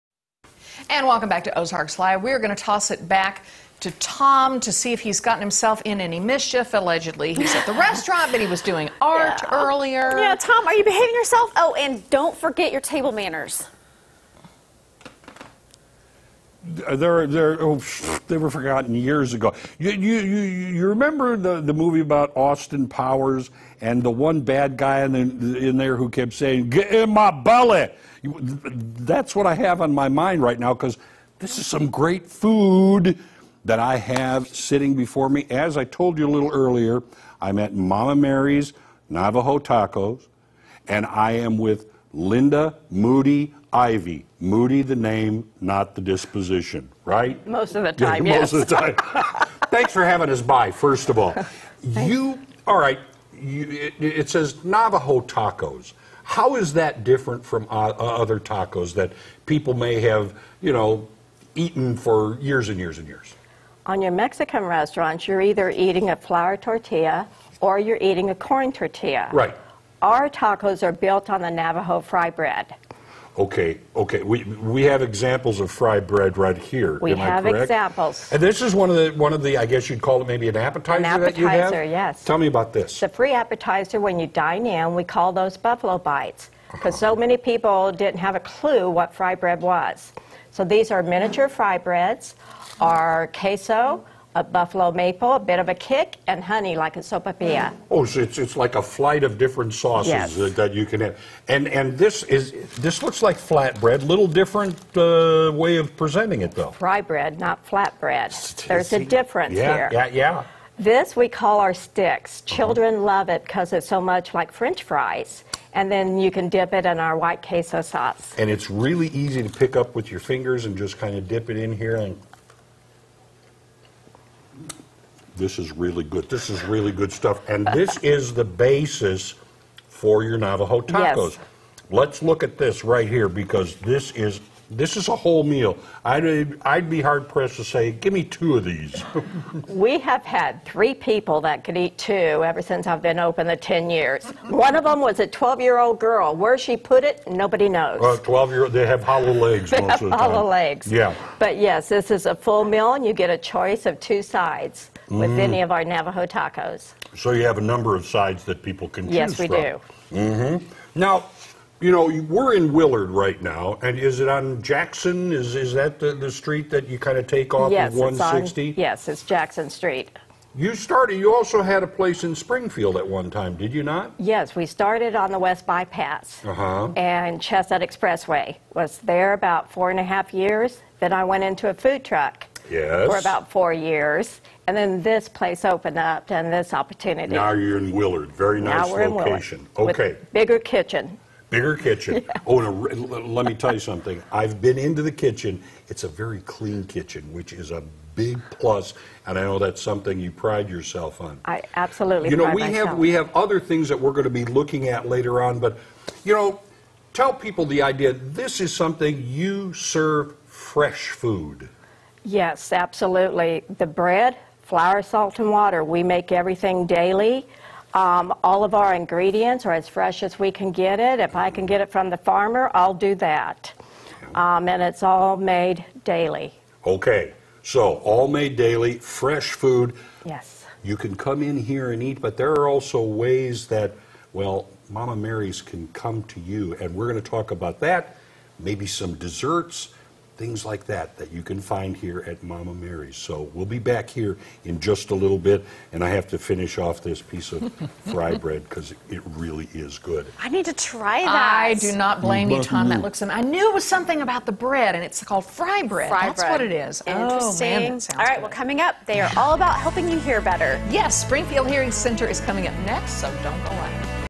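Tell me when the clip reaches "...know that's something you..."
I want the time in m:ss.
3:19.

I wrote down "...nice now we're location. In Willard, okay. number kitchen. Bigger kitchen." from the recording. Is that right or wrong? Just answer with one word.
wrong.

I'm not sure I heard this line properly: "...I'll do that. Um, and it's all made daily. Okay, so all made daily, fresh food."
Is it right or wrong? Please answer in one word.
right.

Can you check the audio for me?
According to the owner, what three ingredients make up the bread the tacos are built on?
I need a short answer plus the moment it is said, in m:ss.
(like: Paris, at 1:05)
flour, salt, and water, at 3:34.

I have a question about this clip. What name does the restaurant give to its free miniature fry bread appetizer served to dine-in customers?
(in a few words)
buffalo bites.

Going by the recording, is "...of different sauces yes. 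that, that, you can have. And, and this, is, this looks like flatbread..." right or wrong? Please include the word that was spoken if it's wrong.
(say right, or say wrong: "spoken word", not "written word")
right.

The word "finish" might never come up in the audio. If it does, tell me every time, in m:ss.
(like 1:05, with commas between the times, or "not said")
4:06.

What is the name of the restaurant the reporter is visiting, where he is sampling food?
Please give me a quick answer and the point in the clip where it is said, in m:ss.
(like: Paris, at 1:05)
Momma Mary's Navajo Tacos, at 0:37.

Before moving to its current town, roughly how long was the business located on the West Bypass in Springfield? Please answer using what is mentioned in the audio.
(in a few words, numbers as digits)
4 and a half years.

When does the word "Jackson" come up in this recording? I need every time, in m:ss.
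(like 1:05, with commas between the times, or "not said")
2:44, 2:49.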